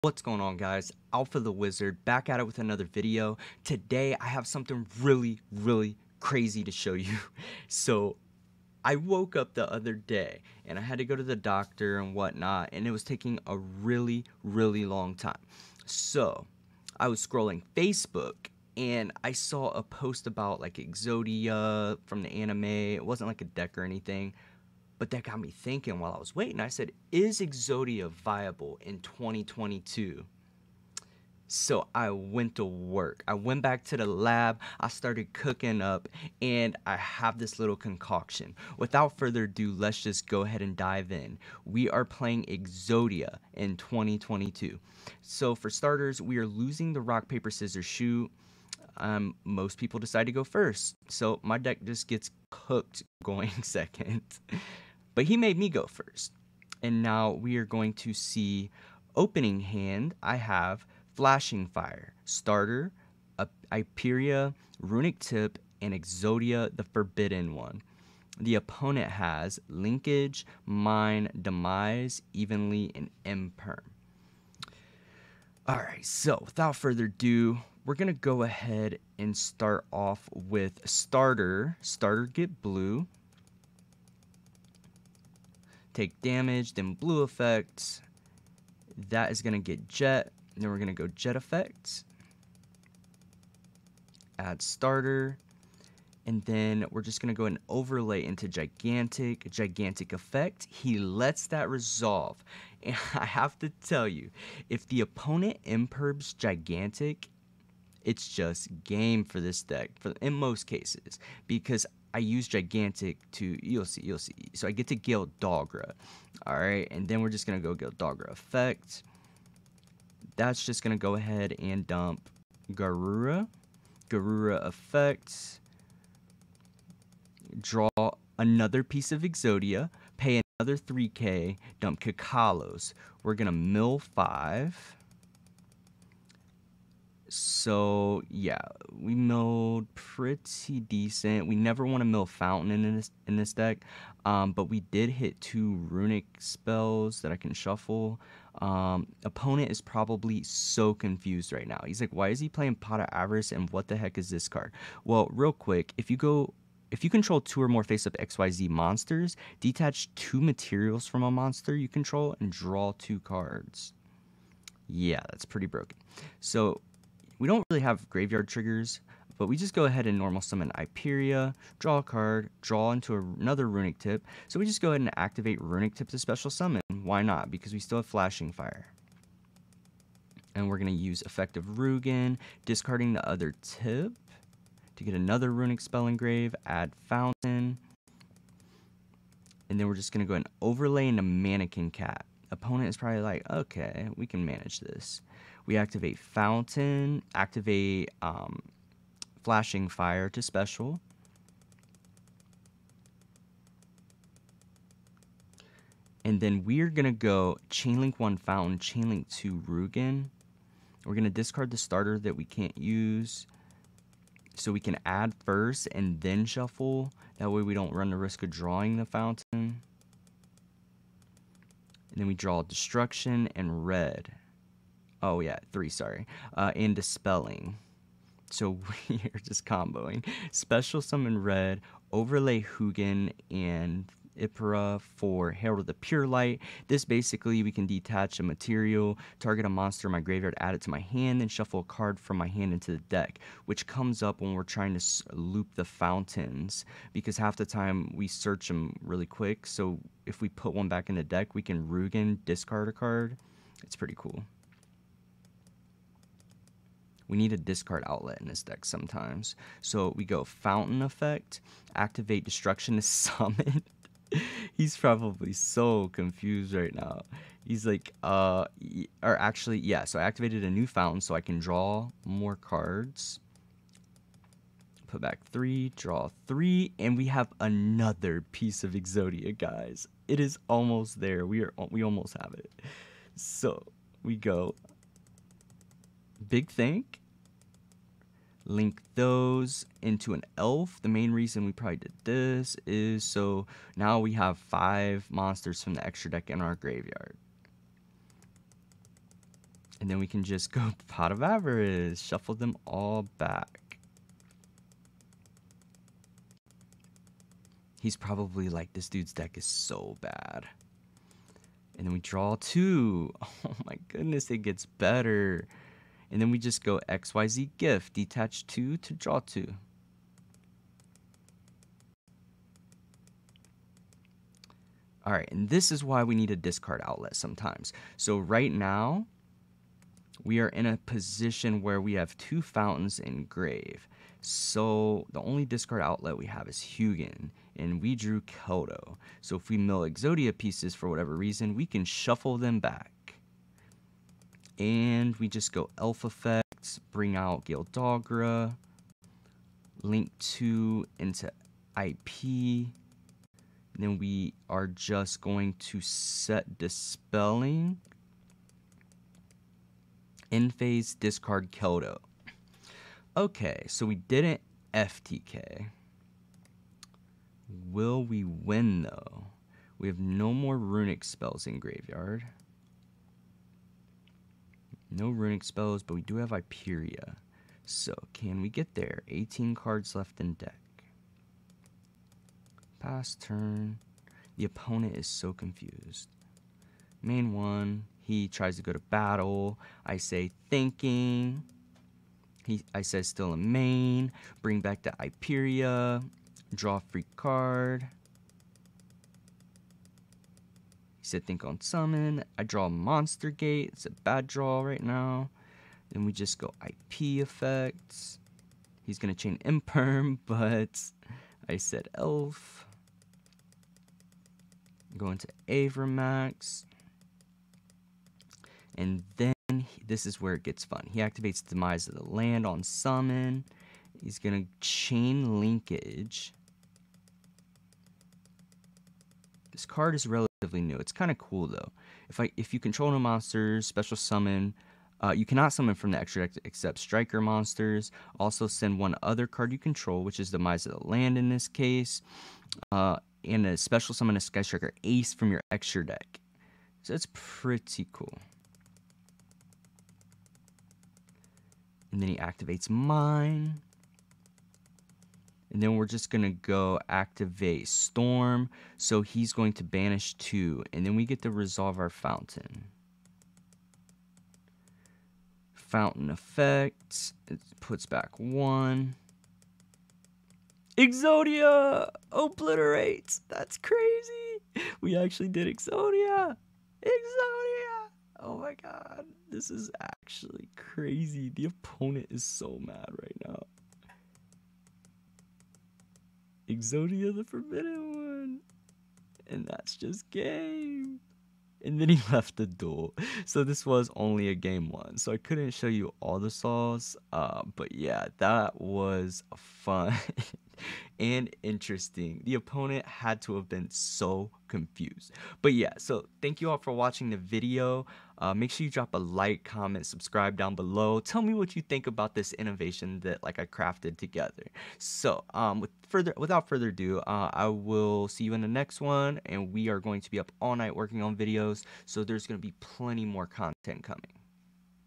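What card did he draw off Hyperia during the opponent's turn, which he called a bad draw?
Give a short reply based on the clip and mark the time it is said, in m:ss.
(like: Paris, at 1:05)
Monster Gate, at 6:42.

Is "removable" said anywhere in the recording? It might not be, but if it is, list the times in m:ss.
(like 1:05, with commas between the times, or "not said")
not said.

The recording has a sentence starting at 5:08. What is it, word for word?
He's probably like, this dude's deck is so bad.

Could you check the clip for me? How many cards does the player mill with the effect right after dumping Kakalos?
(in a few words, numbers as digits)
5.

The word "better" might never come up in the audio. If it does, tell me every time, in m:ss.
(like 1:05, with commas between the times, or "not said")
5:14.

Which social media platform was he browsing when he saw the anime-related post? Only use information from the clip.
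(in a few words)
Facebook.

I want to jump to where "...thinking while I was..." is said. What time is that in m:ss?
0:25.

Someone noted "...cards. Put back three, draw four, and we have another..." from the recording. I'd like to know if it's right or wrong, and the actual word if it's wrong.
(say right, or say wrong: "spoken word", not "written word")
wrong: "three", not "four".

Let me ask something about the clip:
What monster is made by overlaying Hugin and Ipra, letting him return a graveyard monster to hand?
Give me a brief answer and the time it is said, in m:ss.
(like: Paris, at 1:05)
Herald of the Pure Light, at 3:55.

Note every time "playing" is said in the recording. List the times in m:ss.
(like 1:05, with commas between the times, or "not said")
0:42, 2:32.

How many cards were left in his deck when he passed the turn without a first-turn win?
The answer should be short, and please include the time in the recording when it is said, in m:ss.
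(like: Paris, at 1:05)
18, at 6:19.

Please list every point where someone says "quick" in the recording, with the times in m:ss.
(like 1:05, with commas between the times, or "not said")
2:35, 4:09.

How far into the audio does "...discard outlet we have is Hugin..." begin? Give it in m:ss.
5:35.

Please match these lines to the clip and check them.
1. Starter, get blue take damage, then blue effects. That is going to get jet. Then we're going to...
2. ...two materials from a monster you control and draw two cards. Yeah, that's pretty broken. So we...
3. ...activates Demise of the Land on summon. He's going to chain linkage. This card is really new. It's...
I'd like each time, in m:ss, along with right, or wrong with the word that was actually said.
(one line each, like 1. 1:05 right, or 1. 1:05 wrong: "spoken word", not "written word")
1. 1:21 right
2. 2:40 right
3. 7:01 right.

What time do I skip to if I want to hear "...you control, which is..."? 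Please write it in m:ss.
7:19.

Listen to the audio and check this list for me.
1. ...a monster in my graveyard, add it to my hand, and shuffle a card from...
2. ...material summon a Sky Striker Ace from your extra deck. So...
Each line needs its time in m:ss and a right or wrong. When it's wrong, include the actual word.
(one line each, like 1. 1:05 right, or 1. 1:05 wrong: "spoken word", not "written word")
1. 3:59 right
2. 7:23 wrong: "special", not "material".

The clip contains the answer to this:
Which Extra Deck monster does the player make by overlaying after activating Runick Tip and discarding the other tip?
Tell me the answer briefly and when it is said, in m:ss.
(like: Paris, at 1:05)
Mannequin Cat, at 3:11.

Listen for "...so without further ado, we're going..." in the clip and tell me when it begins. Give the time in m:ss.
1:16.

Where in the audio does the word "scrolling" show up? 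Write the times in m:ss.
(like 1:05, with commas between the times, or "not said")
0:17.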